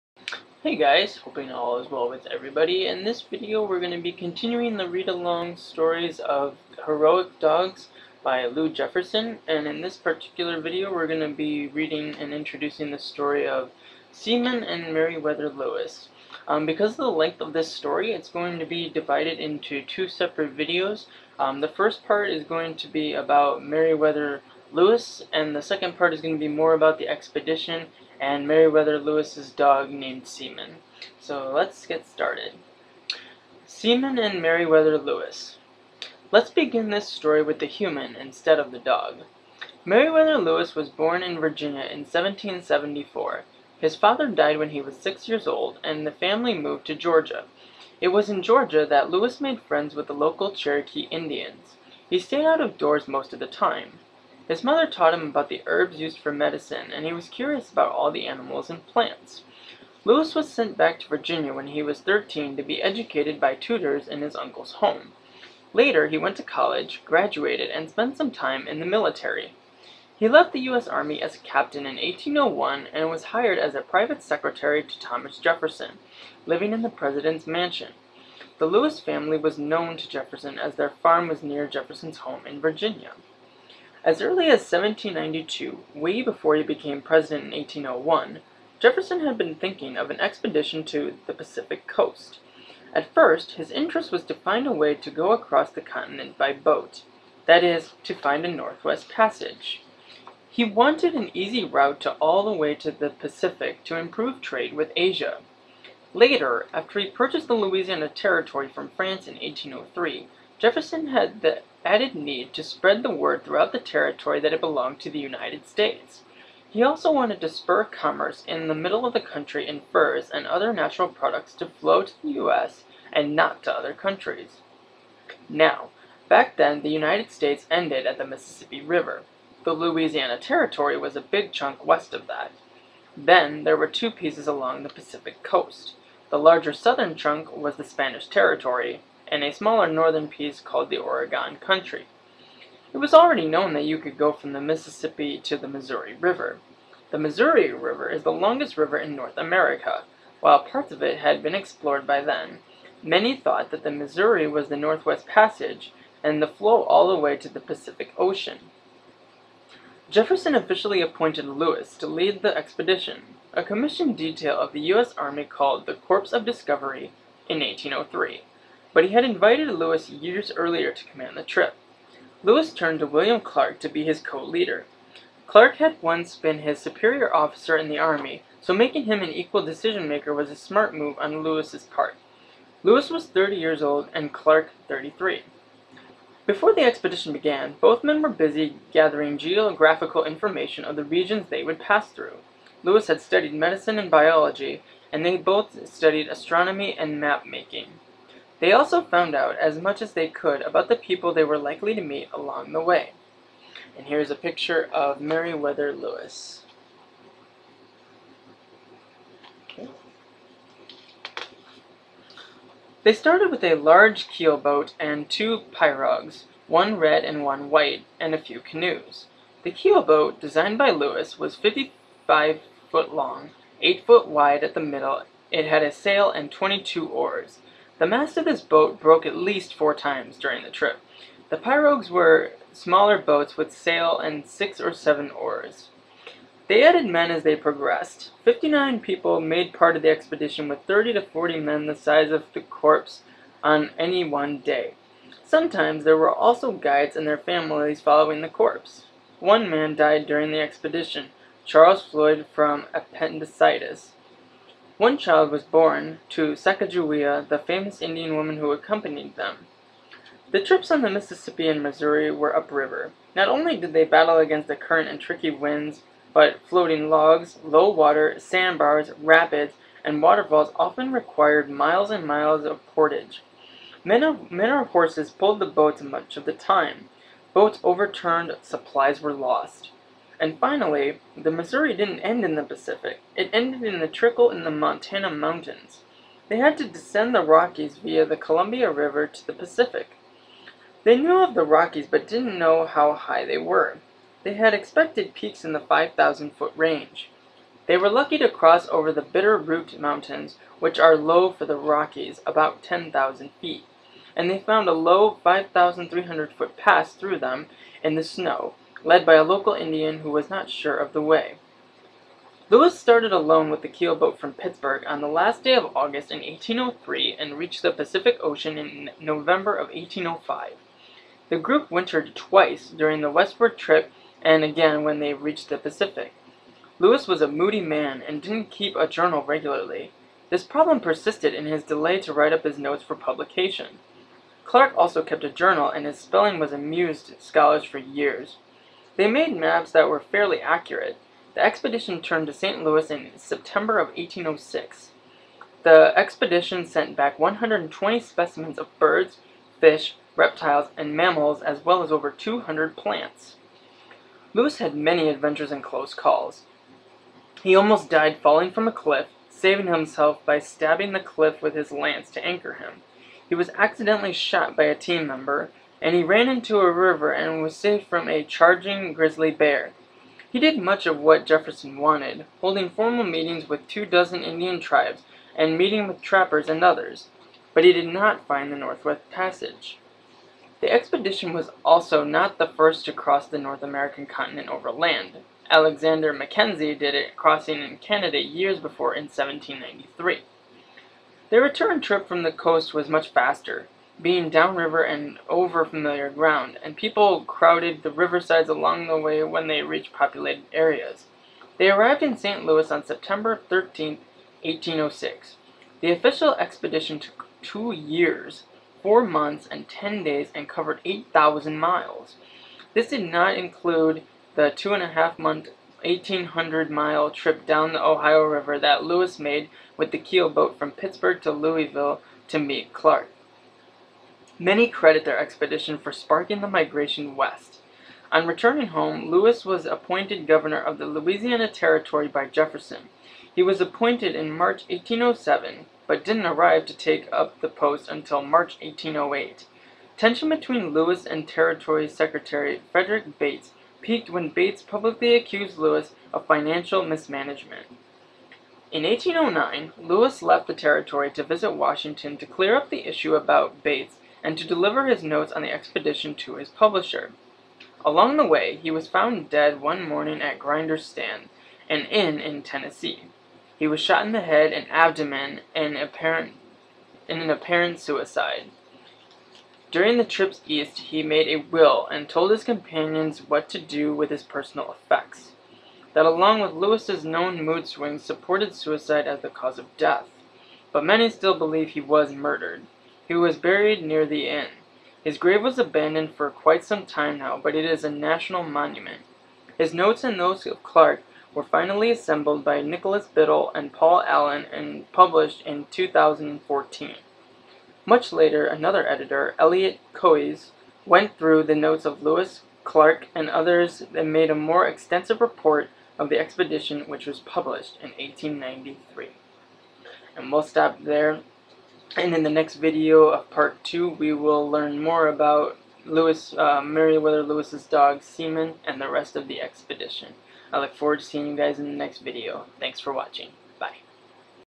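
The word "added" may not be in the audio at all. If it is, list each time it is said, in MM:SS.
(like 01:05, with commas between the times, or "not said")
01:51, 03:56.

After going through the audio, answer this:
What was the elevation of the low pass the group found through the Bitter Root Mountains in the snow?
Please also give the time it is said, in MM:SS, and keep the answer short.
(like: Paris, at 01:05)
5,300 feet, at 05:05.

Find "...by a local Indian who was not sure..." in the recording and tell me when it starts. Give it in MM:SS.
05:09.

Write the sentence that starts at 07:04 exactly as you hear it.
Many credit their expedition for sparking the migration west.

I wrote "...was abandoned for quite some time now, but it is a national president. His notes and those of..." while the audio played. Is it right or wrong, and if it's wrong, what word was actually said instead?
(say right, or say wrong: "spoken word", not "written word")
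wrong: "monument", not "president".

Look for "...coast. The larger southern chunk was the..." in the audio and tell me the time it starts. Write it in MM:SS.
02:15.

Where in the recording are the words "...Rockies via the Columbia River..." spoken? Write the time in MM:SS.
04:47.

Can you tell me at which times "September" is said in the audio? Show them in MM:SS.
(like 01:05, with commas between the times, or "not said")
05:43, 06:43.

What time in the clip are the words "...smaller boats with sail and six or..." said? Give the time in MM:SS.
03:52.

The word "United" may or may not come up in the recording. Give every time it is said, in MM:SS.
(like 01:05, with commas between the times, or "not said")
01:55, 02:06.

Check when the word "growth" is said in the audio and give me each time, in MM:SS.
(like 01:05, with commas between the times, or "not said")
not said.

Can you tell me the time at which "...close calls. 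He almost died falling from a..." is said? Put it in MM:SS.
05:55.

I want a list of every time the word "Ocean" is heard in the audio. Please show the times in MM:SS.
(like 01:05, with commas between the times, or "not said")
02:38, 05:18.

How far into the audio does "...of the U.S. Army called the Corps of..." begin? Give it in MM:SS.
02:44.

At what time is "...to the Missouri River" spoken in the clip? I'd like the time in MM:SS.
02:25.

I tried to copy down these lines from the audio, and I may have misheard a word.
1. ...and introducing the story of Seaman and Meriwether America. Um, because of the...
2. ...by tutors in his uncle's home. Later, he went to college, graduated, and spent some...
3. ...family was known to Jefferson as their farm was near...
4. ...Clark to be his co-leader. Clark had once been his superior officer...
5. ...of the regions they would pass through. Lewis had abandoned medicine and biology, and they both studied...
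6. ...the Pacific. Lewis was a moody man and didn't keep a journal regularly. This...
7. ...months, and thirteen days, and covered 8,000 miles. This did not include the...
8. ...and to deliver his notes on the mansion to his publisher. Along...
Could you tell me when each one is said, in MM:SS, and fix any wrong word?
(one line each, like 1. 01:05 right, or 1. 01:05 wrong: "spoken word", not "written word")
1. 00:12 wrong: "Lewis", not "America"
2. 01:03 right
3. 01:18 right
4. 02:53 right
5. 03:10 wrong: "studied", not "abandoned"
6. 05:25 right
7. 06:49 wrong: "ten", not "thirteen"
8. 07:34 wrong: "expedition", not "mansion".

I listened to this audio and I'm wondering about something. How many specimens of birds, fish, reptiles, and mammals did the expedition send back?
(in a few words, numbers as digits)
120.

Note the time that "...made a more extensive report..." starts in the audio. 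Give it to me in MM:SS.
08:24.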